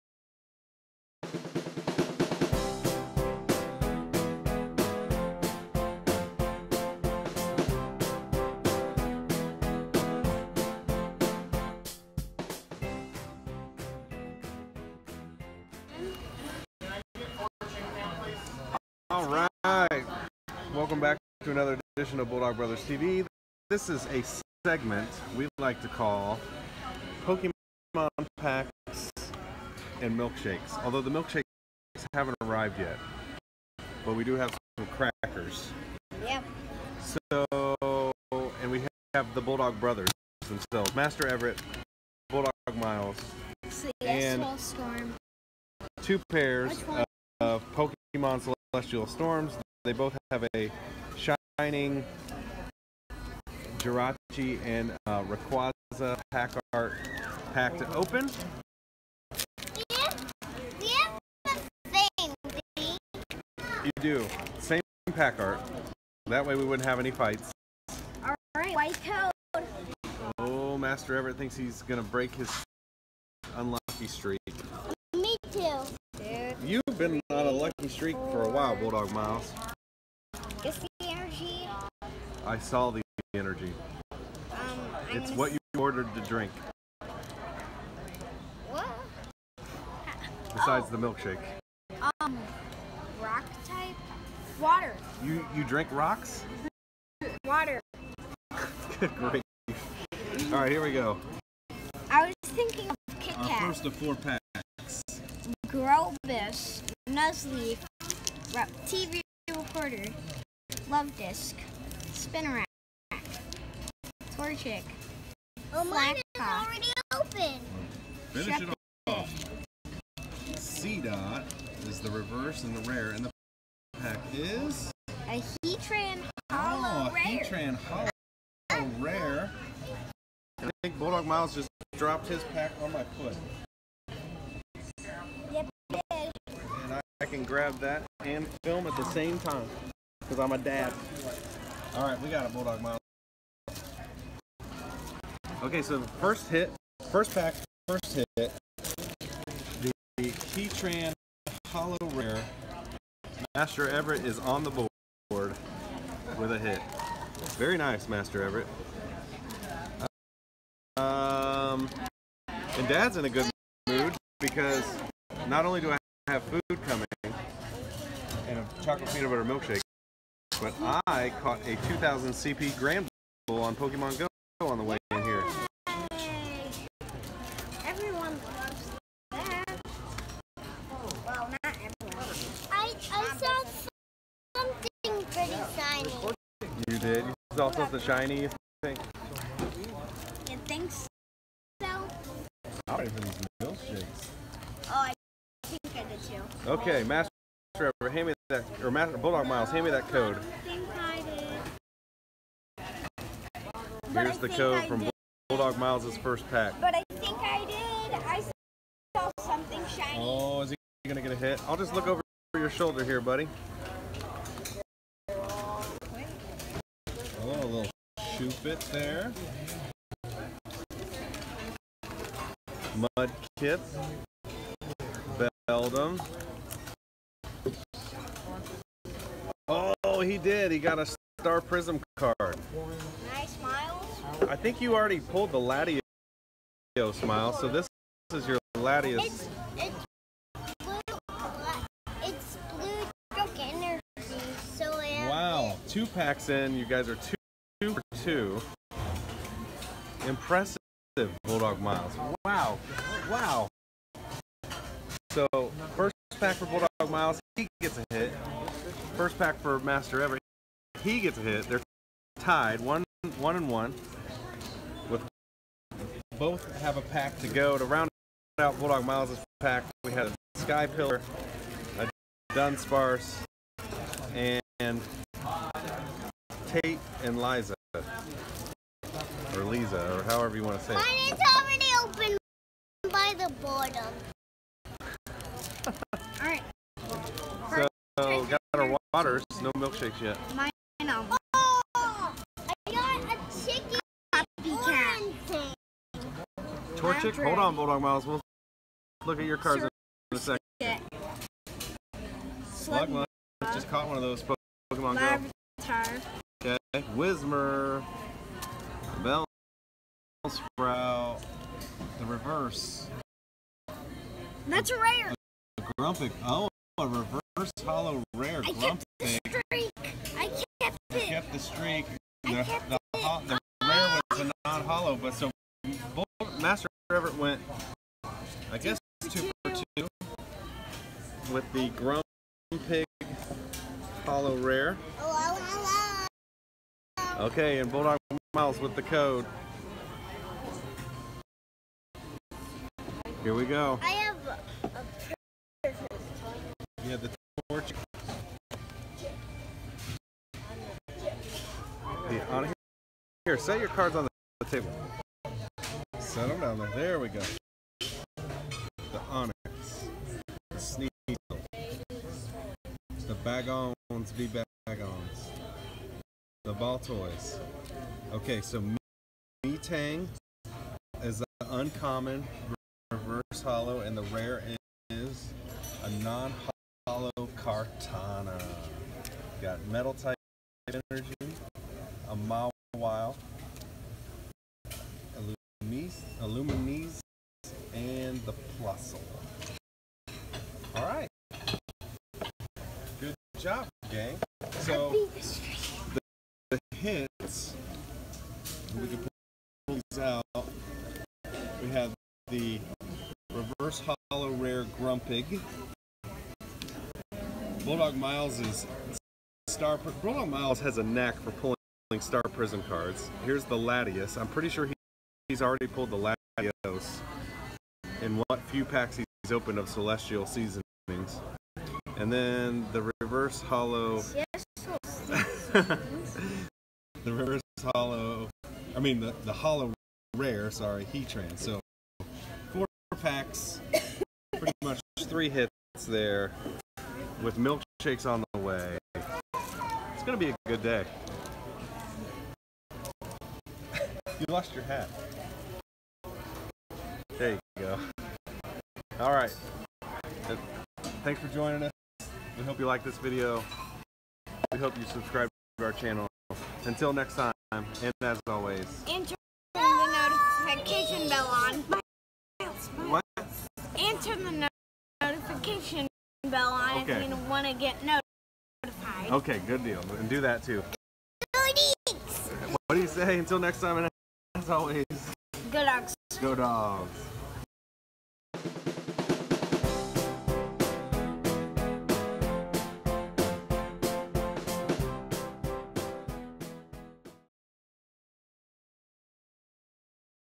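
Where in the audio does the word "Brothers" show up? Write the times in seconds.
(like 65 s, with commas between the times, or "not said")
22 s, 39 s.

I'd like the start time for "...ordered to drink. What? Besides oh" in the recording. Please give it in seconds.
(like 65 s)
85 s.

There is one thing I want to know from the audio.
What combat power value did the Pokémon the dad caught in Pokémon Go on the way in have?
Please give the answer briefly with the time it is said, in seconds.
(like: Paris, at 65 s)
2000, at 171 s.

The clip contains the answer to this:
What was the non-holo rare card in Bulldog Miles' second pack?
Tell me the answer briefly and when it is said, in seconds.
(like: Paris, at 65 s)
Kartana, at 377 s.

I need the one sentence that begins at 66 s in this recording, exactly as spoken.
That way we wouldn't have any fights.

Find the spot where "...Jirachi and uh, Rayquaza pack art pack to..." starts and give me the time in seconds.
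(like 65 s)
53 s.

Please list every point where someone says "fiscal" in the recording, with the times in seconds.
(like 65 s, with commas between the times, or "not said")
not said.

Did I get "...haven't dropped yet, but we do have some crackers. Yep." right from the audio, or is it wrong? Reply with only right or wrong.
wrong.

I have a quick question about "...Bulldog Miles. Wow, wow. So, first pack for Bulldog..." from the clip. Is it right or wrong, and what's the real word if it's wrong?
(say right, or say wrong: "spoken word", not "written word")
right.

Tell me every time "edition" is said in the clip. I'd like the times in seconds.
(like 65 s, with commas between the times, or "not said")
21 s.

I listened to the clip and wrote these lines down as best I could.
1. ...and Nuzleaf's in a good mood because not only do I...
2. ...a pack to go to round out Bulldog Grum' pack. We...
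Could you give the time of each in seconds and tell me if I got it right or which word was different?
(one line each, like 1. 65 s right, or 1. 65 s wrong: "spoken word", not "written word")
1. 162 s wrong: "Dad", not "Nuzleaf"
2. 266 s wrong: "Miles", not "Grum".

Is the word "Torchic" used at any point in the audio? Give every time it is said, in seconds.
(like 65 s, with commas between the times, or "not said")
114 s, 296 s.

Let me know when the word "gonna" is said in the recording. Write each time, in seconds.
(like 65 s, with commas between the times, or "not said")
71 s, 211 s, 440 s.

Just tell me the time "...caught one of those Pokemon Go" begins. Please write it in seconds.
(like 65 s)
303 s.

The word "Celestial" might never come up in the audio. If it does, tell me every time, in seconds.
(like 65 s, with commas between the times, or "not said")
48 s, 419 s.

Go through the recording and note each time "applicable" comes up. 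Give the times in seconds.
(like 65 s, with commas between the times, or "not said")
not said.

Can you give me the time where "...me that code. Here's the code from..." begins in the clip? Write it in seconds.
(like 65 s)
199 s.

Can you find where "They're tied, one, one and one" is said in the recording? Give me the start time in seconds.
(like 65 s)
261 s.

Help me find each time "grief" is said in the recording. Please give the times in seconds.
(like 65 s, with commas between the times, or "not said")
99 s.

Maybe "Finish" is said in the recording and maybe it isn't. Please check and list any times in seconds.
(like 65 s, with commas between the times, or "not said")
118 s.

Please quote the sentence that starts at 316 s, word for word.
Oh, a reverse first holo rare I grump thing.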